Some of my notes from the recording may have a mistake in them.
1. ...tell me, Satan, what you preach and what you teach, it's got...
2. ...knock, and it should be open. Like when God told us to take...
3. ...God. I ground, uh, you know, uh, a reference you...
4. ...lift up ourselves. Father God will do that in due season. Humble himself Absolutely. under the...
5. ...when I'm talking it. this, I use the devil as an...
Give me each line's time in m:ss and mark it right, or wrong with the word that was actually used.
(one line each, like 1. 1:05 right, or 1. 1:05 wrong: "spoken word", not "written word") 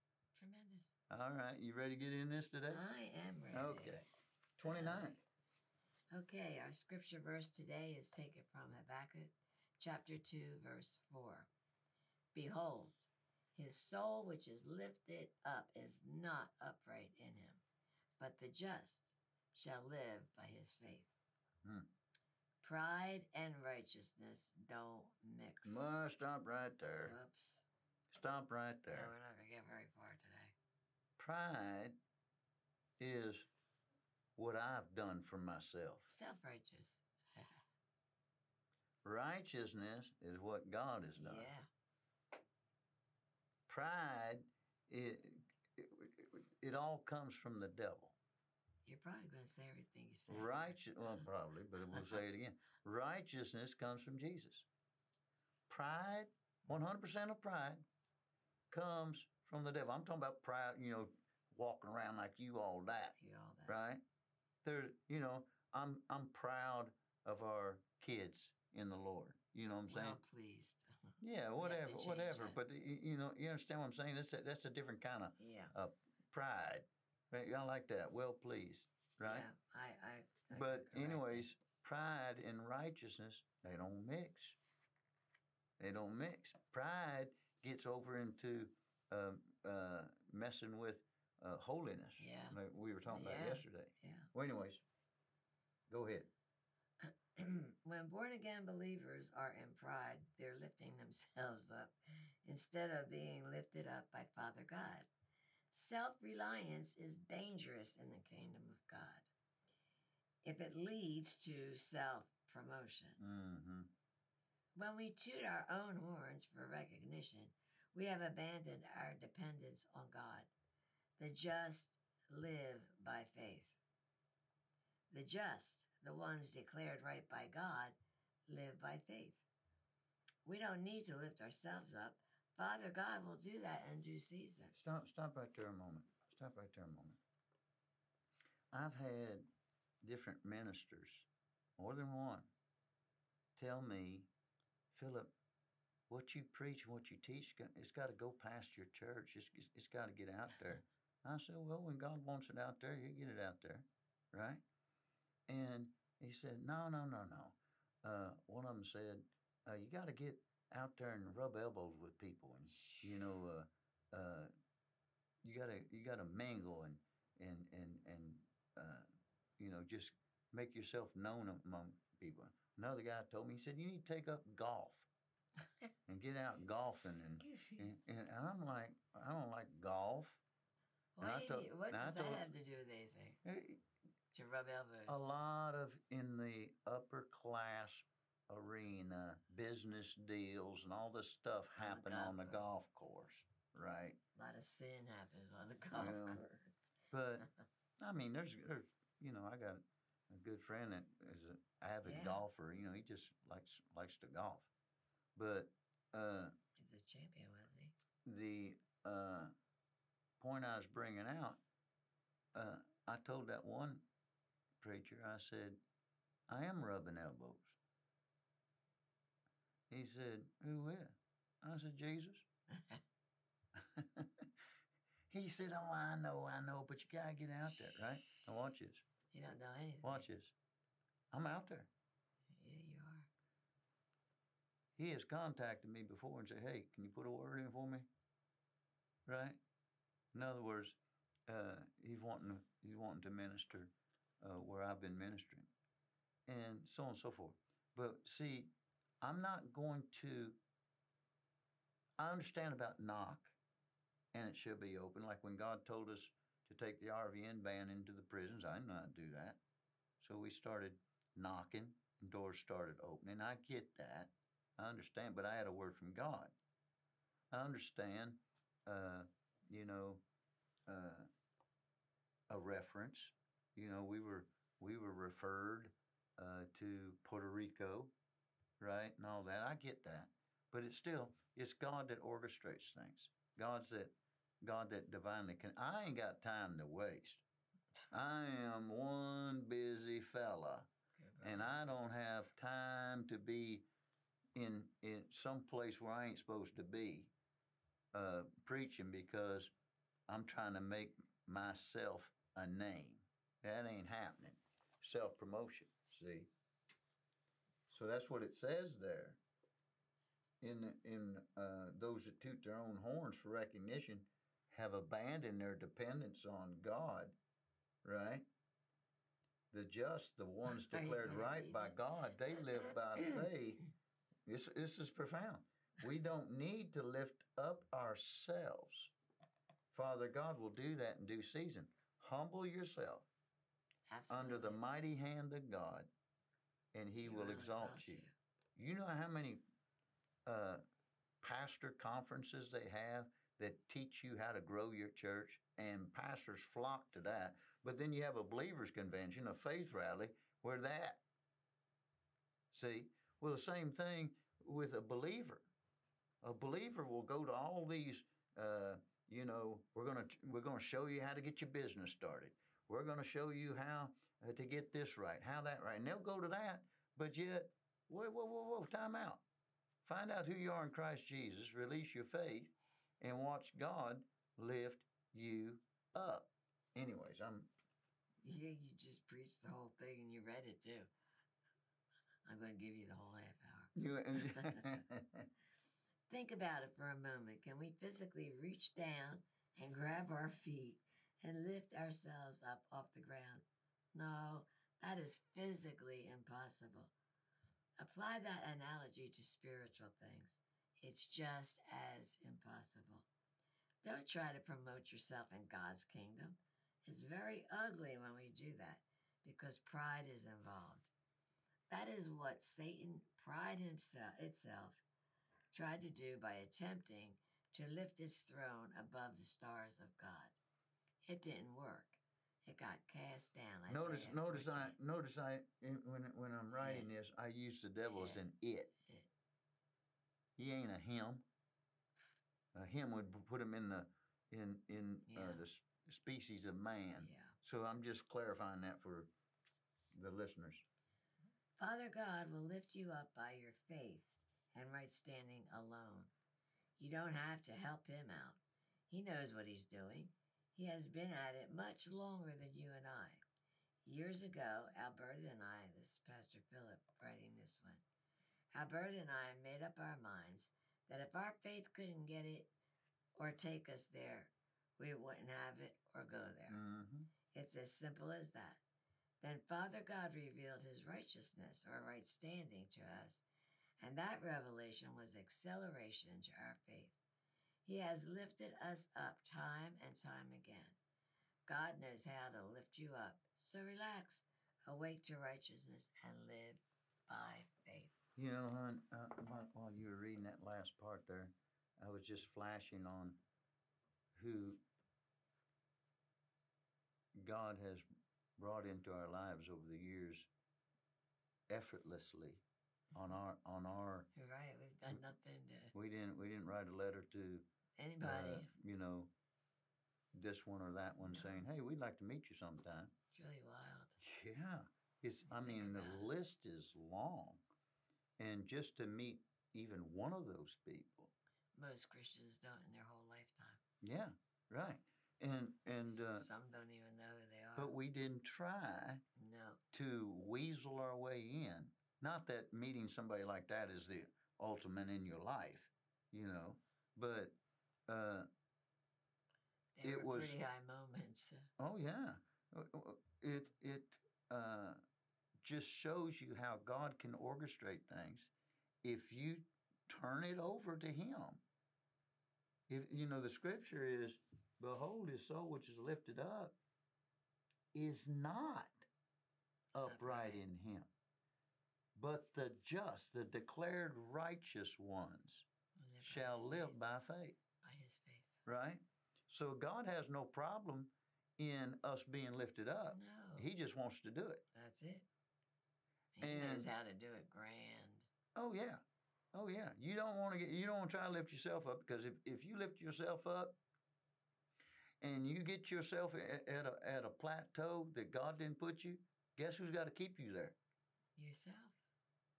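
1. 2:23 wrong: "Philip", not "Satan"
2. 4:12 right
3. 4:26 wrong: "understand", not "ground"
4. 5:27 wrong: "yourself", not "himself"
5. 7:06 wrong: "writing", not "talking".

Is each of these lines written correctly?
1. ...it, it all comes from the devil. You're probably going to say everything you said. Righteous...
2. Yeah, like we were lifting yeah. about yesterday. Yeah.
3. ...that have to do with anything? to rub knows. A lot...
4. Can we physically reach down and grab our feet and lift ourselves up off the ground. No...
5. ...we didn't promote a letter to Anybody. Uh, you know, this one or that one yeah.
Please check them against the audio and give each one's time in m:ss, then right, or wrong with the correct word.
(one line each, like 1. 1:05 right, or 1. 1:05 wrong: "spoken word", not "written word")
1. 0:45 right
2. 1:32 wrong: "talking", not "lifting"
3. 3:02 wrong: "elbows", not "knows"
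4. 6:27 right
5. 8:26 wrong: "write", not "promote".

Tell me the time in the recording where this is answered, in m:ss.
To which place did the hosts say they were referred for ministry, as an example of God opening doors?
4:37.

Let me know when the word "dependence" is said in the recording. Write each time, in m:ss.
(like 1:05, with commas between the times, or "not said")
1:59, 5:15.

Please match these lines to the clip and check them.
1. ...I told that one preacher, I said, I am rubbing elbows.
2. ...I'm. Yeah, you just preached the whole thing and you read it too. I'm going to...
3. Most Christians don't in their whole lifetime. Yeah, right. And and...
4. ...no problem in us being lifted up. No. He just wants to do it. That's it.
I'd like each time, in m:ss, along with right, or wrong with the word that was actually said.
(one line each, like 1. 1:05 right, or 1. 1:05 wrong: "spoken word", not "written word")
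1. 3:33 right
2. 6:17 right
3. 8:41 right
4. 9:30 right.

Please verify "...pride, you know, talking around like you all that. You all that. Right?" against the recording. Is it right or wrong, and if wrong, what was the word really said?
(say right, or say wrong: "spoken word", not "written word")
wrong: "walking", not "talking".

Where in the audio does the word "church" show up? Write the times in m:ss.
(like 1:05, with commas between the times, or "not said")
2:28, 5:45.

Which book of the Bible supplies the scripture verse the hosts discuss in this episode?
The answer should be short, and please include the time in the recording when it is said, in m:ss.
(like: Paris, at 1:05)
Habakkuk, at 0:08.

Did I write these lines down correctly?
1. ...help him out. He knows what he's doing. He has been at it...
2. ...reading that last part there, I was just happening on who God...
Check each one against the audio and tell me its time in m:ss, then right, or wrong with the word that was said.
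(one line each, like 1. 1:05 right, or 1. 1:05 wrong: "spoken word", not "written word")
1. 7:27 right
2. 8:10 wrong: "flashing", not "happening".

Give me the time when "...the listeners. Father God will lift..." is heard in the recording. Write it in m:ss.
7:20.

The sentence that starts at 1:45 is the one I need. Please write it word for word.
Self reliance is dangerous in the kingdom of God if it leads to self promotion.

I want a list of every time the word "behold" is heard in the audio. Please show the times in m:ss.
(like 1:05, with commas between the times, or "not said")
0:12, 9:14.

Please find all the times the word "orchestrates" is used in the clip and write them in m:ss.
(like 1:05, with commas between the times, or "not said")
4:42, 9:07.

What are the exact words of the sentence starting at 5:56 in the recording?
A believer will go to all these.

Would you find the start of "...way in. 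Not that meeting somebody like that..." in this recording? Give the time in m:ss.
8:51.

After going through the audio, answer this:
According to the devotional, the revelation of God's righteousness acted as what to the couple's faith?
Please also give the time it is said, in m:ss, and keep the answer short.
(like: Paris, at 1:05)
Acceleration, at 7:55.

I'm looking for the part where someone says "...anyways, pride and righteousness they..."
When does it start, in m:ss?
1:20.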